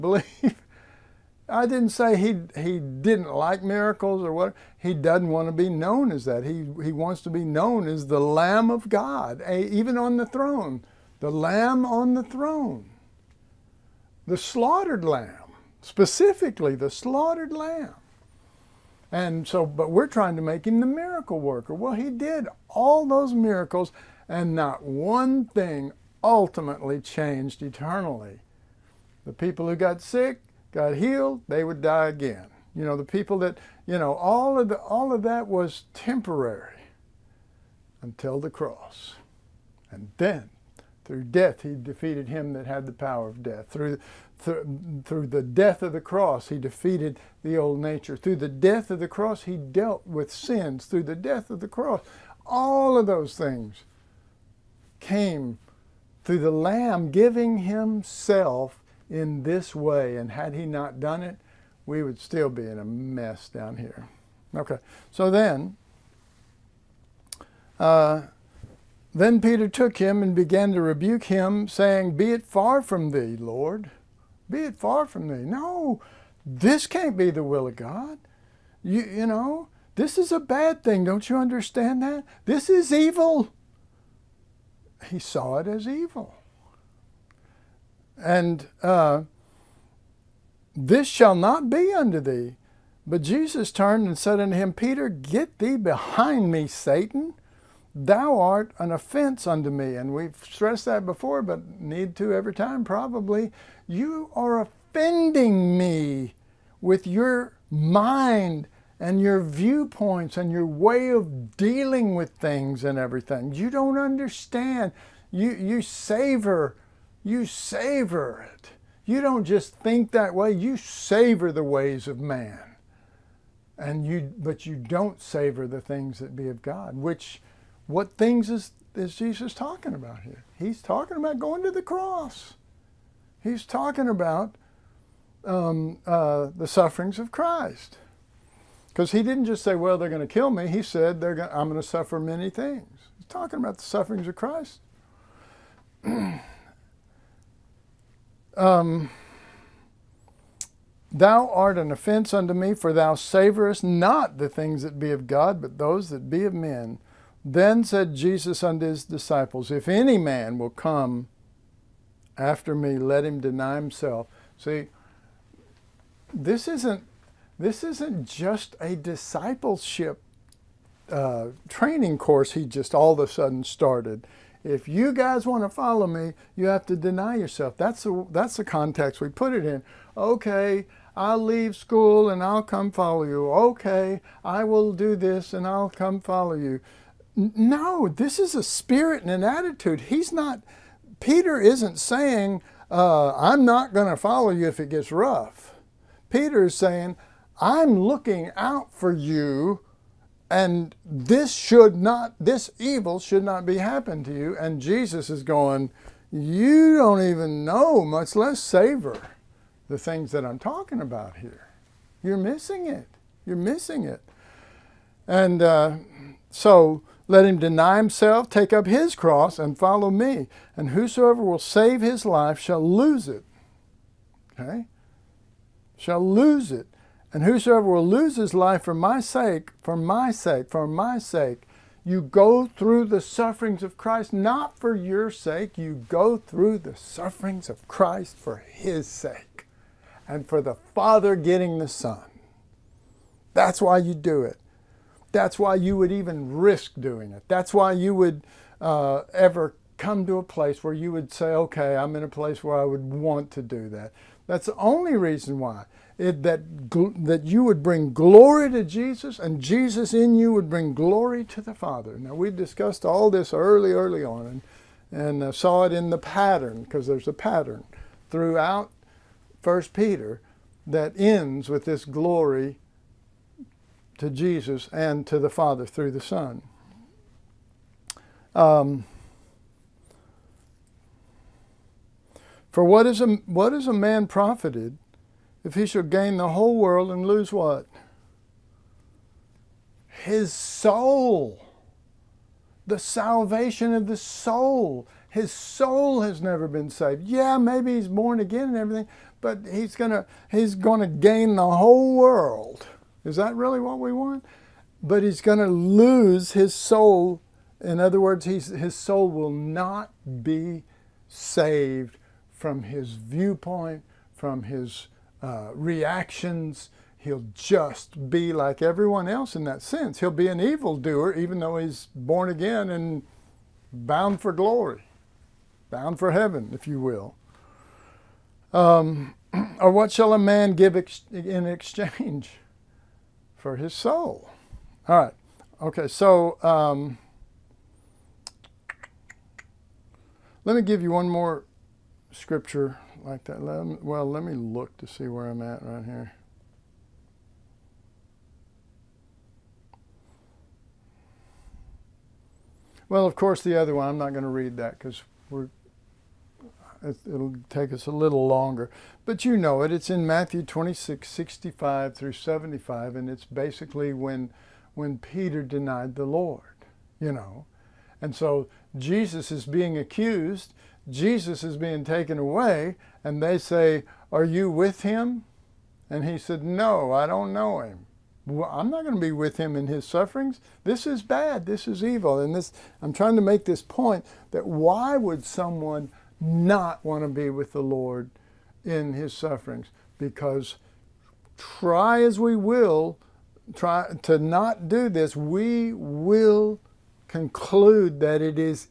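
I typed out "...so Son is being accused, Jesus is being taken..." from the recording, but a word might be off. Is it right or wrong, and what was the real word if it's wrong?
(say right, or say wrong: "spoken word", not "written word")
wrong: "Jesus", not "Son".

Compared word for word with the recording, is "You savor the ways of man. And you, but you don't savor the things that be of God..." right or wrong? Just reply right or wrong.
right.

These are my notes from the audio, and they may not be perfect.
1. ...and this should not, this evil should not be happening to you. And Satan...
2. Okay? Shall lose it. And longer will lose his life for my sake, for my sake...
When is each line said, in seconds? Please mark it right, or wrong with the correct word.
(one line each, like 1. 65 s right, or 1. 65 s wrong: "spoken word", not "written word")
1. 200 s wrong: "Jesus", not "Satan"
2. 224 s wrong: "whosoever", not "longer".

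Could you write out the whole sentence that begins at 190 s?
He's not, Peter isn't saying, uh, I'm not going to follow you if it gets rough.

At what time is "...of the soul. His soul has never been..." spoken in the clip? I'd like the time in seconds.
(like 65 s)
293 s.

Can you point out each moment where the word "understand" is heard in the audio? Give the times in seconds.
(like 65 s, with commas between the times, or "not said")
81 s, 113 s.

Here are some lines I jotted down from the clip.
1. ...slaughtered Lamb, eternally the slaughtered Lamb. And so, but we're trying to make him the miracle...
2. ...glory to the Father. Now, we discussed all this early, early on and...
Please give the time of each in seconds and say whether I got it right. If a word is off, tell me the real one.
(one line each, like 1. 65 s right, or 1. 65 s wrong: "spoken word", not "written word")
1. 14 s wrong: "specifically", not "eternally"
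2. 260 s right.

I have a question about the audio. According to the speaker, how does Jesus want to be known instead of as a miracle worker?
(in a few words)
The Lamb of God.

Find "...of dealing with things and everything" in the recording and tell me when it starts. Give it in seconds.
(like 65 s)
111 s.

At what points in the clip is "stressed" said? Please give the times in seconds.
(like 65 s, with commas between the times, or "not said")
100 s.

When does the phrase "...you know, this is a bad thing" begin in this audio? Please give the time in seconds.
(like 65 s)
79 s.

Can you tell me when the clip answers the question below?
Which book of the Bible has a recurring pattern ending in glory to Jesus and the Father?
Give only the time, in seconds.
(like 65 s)
269 s.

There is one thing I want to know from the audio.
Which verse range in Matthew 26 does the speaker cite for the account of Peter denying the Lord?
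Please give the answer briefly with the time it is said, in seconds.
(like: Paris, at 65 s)
65 through 75, at 361 s.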